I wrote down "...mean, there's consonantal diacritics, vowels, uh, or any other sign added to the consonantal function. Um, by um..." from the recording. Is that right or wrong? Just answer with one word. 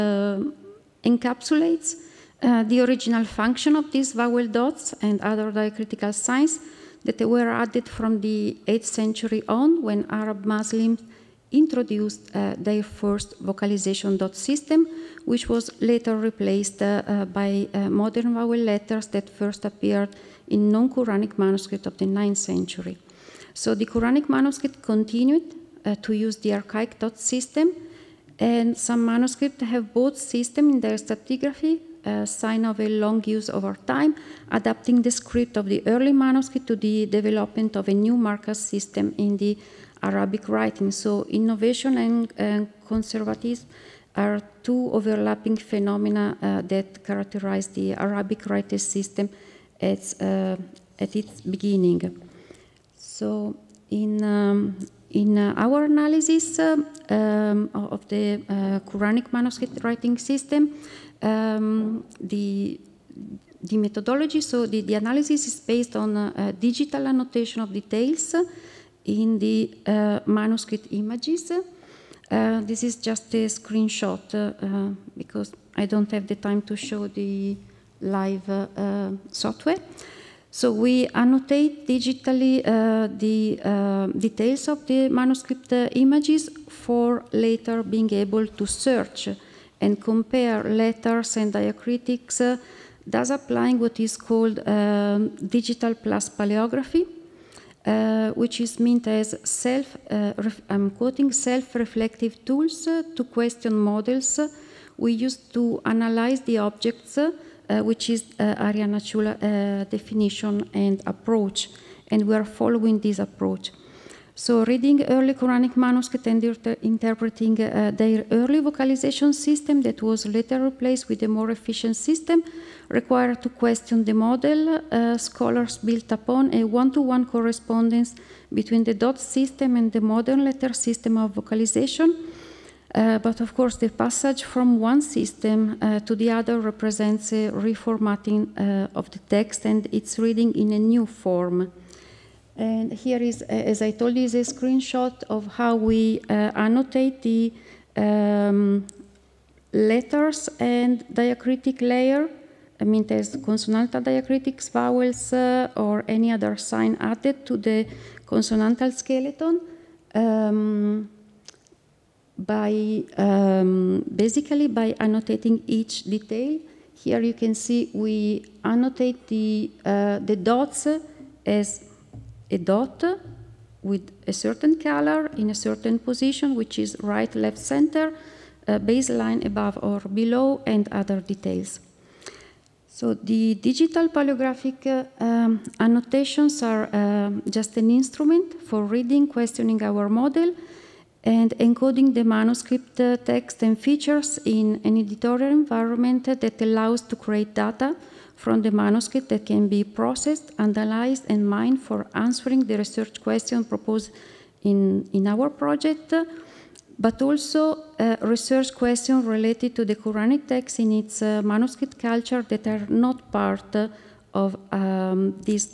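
wrong.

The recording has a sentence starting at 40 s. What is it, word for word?
So innovation and, and conservatism are two overlapping phenomena uh, that characterize the Arabic writing system at, uh, at its beginning.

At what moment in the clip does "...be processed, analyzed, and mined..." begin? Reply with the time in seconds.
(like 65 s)
199 s.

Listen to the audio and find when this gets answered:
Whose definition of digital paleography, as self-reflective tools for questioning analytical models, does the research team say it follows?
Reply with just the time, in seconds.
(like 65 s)
108 s.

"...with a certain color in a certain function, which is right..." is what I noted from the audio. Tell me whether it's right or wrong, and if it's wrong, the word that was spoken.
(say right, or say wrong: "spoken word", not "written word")
wrong: "position", not "function".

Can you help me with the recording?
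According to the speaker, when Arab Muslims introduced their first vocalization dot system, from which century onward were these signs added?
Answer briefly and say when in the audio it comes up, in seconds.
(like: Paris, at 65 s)
8th century, at 8 s.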